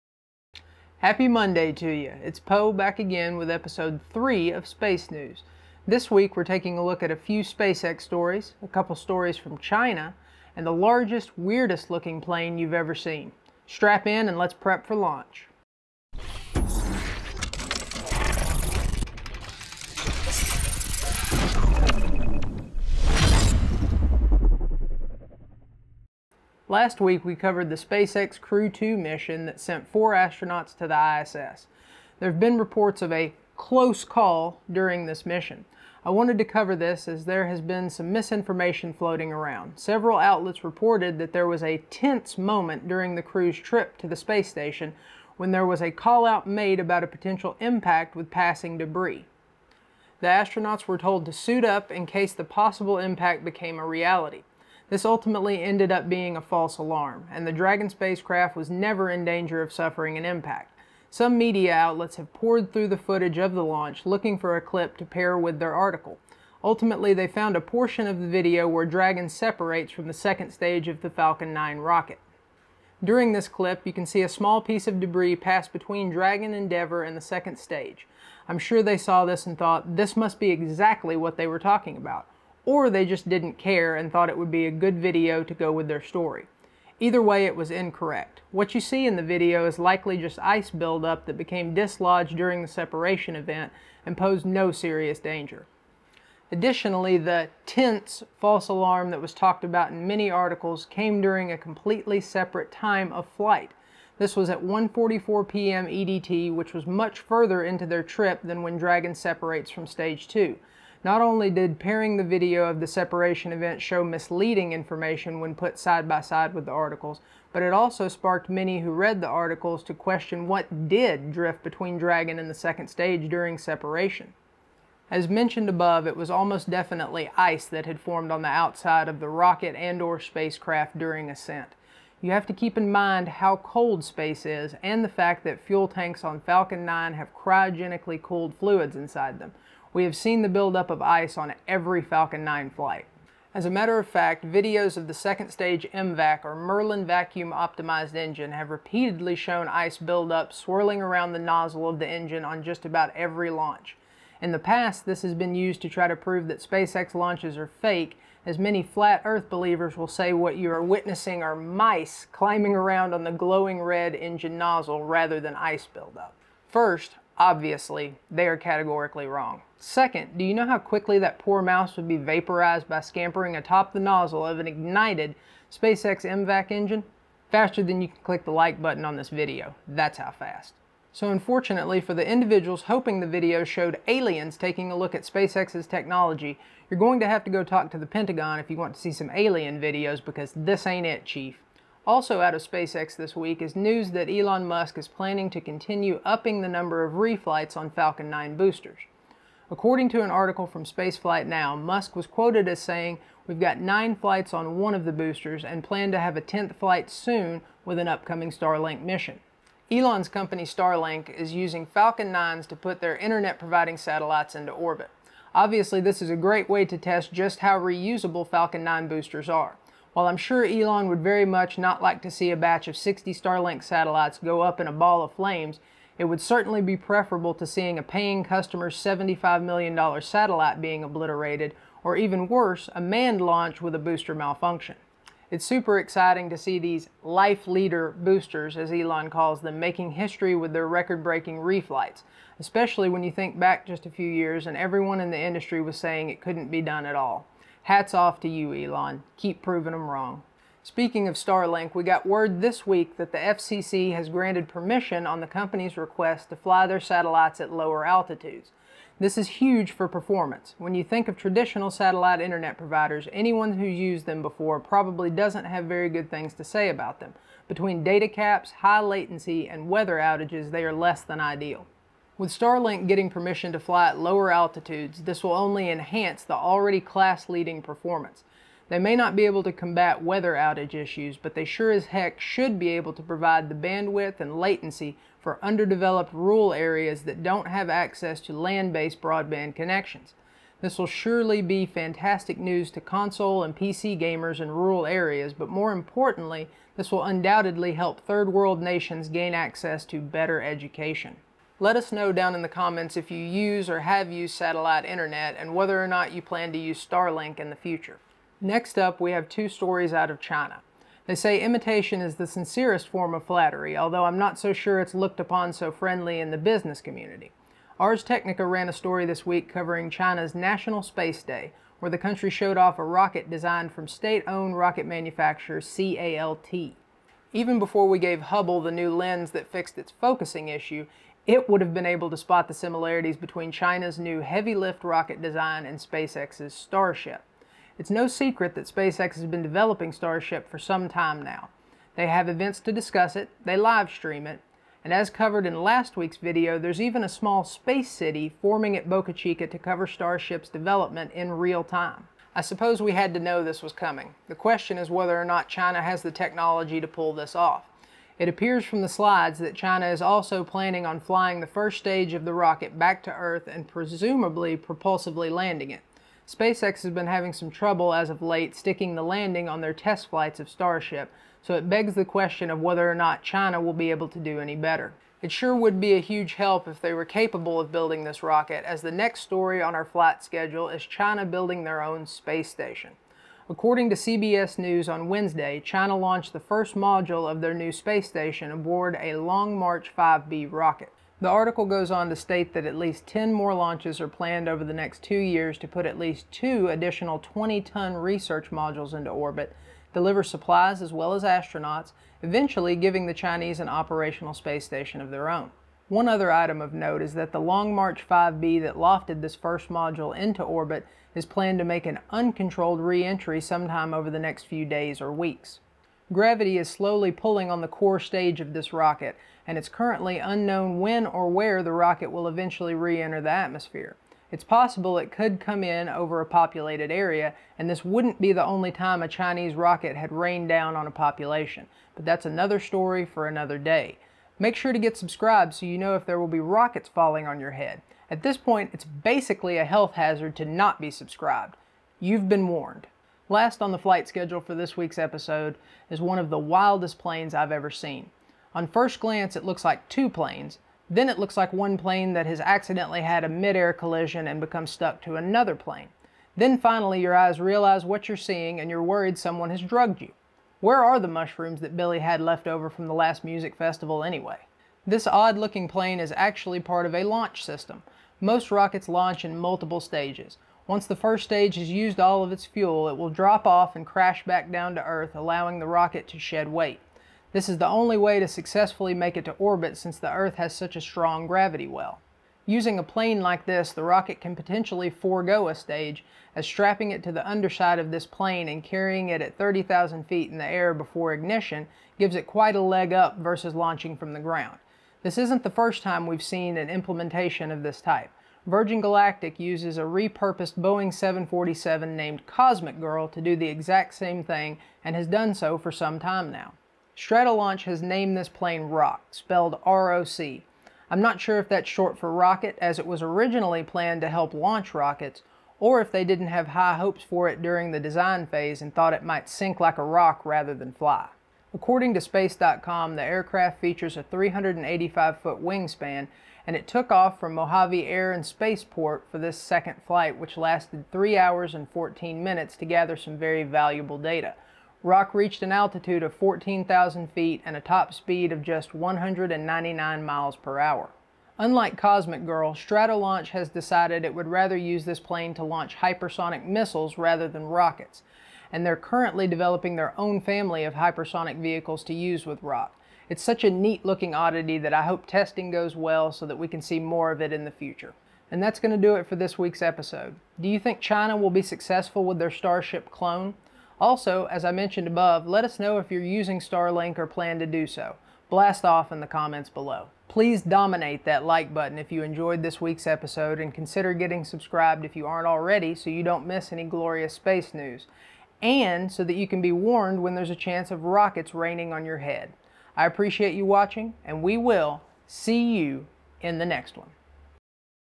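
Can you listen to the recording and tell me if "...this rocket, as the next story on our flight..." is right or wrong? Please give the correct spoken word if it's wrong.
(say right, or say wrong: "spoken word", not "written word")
right.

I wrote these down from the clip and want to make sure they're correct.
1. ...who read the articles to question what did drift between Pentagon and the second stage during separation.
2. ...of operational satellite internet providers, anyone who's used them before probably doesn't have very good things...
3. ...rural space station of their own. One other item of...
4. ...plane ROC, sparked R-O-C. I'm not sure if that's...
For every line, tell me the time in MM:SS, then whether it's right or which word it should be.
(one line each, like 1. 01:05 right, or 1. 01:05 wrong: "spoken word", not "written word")
1. 01:58 wrong: "Dragon", not "Pentagon"
2. 04:21 wrong: "traditional", not "operational"
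3. 06:43 wrong: "operational", not "rural"
4. 08:28 wrong: "spelled", not "sparked".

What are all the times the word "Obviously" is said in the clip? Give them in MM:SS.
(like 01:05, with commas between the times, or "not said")
02:47, 03:35.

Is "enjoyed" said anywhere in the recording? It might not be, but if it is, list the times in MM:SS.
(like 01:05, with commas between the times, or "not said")
09:32.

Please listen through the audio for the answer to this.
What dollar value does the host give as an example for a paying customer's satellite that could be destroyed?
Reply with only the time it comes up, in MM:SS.
03:48.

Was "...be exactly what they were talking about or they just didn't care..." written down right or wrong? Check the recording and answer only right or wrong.
right.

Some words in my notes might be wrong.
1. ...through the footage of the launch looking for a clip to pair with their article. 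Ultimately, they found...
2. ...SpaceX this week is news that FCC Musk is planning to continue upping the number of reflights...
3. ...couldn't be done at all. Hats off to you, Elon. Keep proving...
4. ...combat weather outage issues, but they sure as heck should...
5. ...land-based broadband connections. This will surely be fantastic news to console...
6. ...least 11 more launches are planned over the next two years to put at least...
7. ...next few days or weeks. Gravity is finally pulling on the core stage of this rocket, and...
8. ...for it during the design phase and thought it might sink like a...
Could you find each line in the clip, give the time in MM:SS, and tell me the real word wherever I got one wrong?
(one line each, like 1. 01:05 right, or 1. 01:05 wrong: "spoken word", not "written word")
1. 01:02 right
2. 03:12 wrong: "Elon", not "FCC"
3. 04:06 right
4. 04:39 right
5. 04:48 right
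6. 06:32 wrong: "10", not "11"
7. 06:54 wrong: "slowly", not "finally"
8. 08:37 right.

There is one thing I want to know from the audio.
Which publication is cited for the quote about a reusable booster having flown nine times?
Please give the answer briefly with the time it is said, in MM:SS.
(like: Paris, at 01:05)
Spaceflight Now, at 03:20.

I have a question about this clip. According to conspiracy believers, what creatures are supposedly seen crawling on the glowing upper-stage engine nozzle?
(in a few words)
Mice.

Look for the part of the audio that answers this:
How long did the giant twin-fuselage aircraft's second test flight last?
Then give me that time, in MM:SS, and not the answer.
08:51.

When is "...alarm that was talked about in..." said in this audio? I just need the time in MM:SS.
01:38.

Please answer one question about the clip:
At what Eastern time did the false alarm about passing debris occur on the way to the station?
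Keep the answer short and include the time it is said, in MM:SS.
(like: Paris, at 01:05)
1:44 p.m. EDT, at 01:44.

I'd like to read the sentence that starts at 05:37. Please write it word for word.
It's no secret that SpaceX has been developing Starship for some time now.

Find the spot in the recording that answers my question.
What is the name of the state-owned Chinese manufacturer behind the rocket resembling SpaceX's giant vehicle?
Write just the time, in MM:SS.
05:25.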